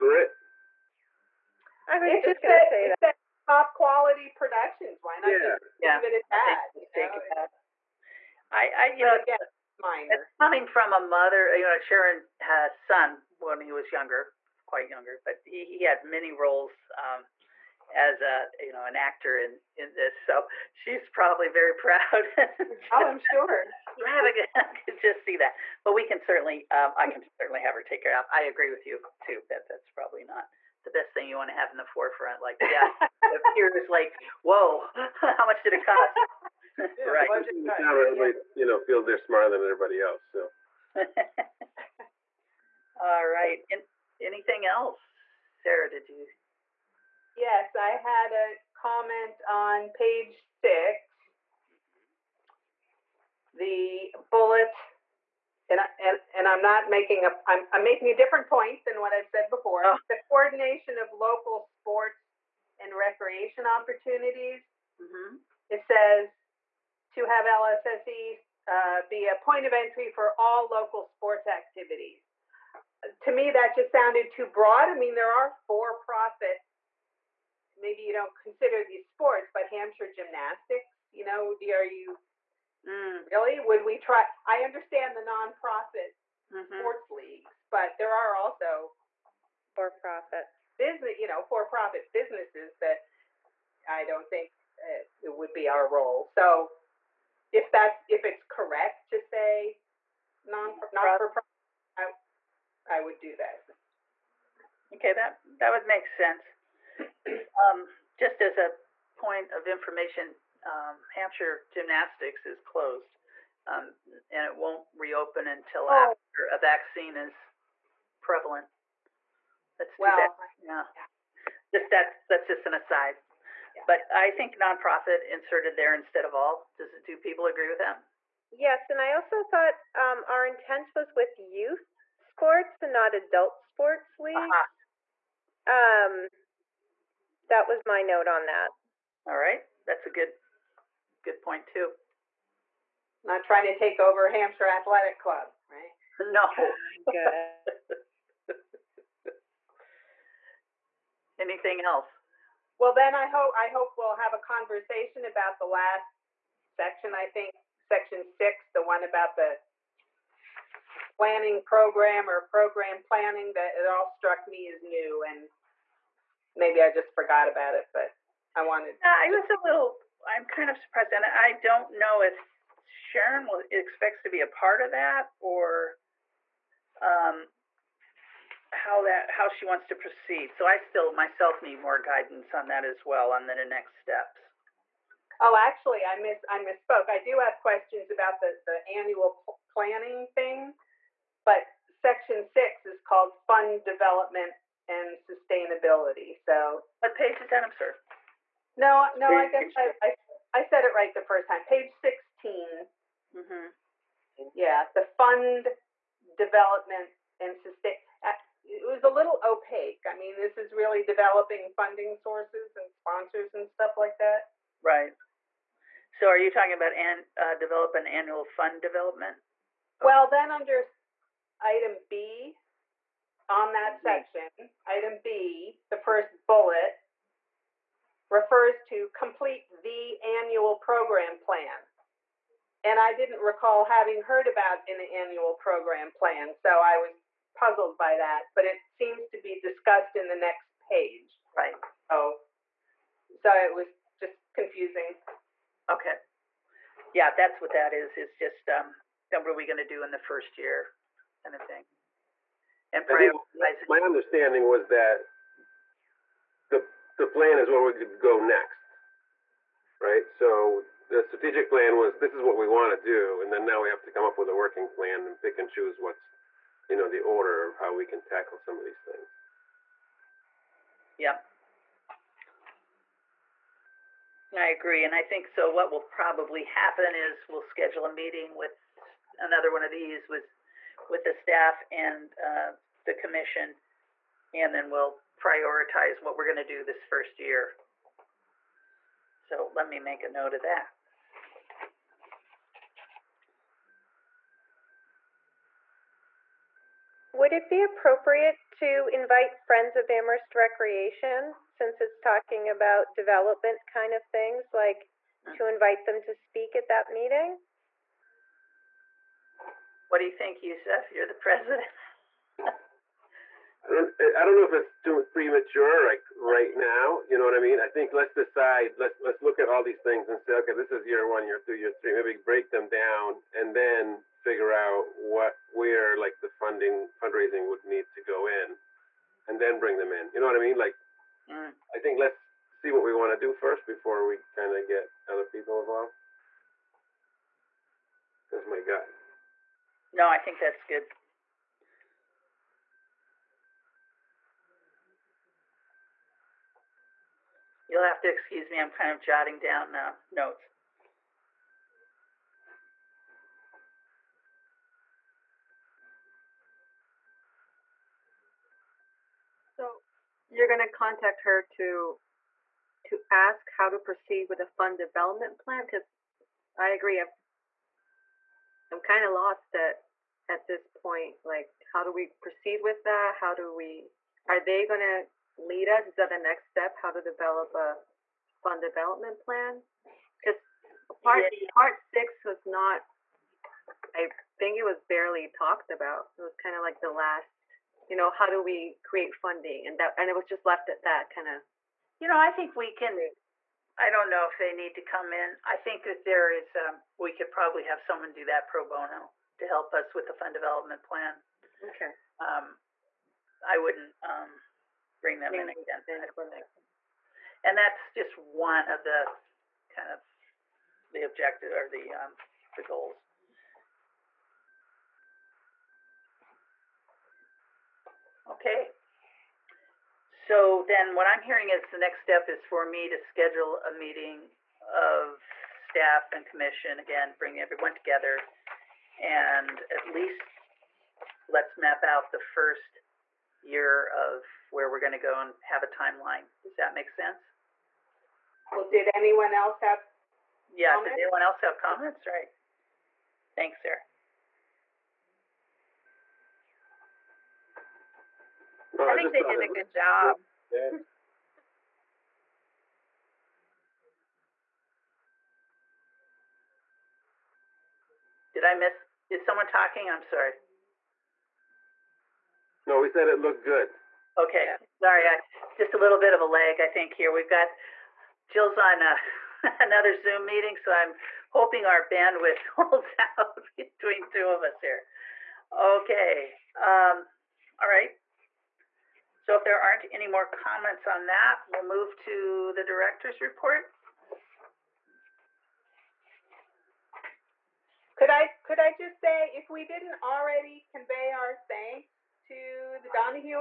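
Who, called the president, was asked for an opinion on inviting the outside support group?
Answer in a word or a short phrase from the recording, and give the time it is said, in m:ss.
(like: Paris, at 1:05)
Yusef, at 5:10.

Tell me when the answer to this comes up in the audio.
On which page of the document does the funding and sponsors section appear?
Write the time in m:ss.
3:21.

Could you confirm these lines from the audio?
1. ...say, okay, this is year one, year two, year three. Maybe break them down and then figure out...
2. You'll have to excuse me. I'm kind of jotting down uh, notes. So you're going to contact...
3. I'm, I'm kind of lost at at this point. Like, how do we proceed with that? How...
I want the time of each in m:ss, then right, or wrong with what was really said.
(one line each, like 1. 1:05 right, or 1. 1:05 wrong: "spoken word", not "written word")
1. 5:20 right
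2. 5:47 right
3. 6:07 right.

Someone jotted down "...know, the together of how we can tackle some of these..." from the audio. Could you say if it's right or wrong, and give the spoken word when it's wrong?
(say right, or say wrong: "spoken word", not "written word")
wrong: "order", not "together".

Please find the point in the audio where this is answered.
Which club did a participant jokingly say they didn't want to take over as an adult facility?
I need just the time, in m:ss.
2:24.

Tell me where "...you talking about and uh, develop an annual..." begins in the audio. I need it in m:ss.
3:36.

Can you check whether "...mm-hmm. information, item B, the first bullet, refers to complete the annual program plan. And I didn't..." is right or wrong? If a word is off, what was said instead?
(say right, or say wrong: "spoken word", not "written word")
wrong: "section", not "information".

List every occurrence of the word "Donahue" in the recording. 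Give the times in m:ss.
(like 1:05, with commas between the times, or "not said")
8:13.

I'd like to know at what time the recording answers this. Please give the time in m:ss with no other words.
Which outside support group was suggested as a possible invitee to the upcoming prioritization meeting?
4:59.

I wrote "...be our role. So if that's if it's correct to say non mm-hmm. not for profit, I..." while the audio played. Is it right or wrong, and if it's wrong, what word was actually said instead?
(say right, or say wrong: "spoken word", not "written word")
right.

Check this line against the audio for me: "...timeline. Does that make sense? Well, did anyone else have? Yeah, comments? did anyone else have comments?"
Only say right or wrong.
right.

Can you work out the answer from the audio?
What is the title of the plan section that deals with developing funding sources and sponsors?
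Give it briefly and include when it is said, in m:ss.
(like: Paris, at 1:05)
fund development and sustainability, at 3:13.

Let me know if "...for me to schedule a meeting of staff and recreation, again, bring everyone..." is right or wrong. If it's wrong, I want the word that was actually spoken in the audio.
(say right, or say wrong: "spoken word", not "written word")
wrong: "commission", not "recreation".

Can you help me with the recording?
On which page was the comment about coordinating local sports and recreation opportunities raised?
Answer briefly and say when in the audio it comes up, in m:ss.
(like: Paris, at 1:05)
6, at 0:49.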